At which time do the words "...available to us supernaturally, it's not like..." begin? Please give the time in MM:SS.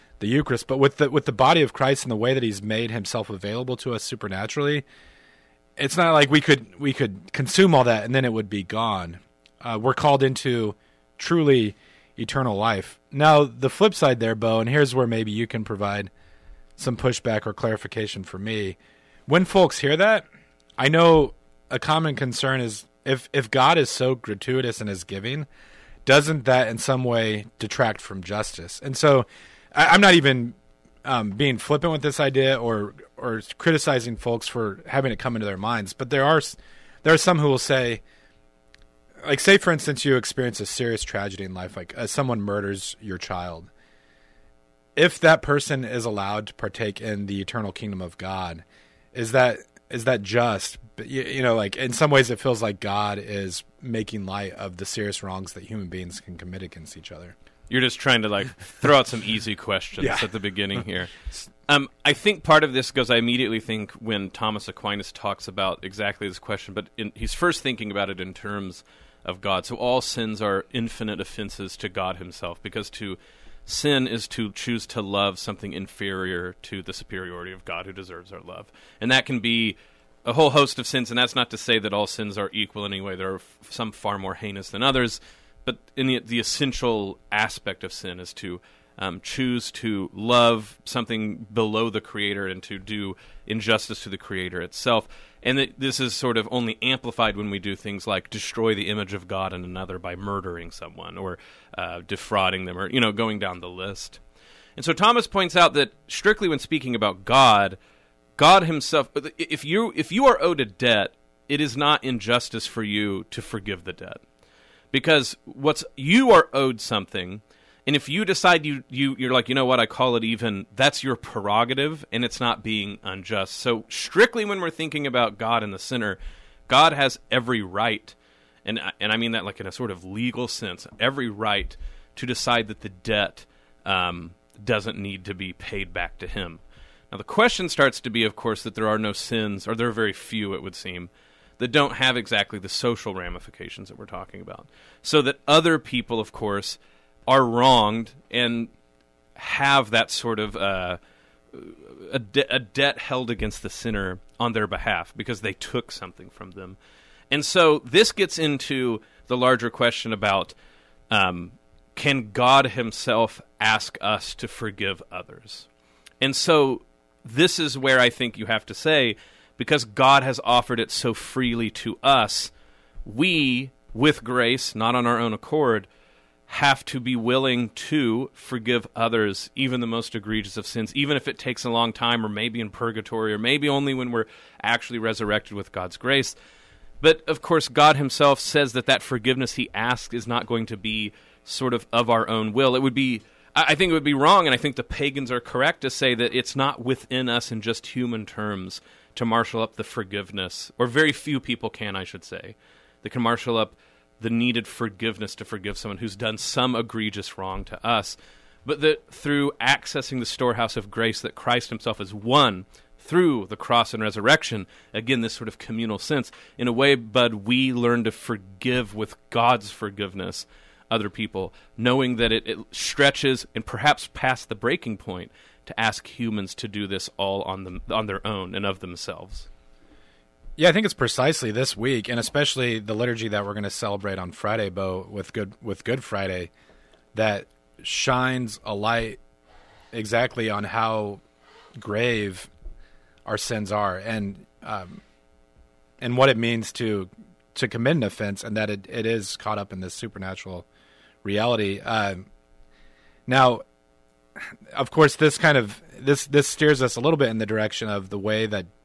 00:03.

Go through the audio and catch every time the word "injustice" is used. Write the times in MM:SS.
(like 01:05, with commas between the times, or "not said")
01:33, 01:52.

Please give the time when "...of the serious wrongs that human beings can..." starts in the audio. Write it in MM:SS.
00:54.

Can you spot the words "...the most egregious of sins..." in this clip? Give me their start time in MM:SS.
02:59.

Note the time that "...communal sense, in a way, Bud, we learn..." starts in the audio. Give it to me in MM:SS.
03:35.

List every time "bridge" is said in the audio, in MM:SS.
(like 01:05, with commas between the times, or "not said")
not said.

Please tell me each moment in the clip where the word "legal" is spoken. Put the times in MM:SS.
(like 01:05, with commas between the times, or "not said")
02:10.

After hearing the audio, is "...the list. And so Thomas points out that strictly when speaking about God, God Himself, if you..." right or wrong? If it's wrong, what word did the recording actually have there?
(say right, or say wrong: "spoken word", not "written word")
right.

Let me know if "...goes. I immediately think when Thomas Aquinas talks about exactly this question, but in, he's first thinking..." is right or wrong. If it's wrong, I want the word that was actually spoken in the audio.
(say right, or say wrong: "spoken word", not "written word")
right.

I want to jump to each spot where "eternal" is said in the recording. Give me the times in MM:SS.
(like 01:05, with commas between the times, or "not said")
00:12, 00:47.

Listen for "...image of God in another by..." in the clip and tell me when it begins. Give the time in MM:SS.
01:38.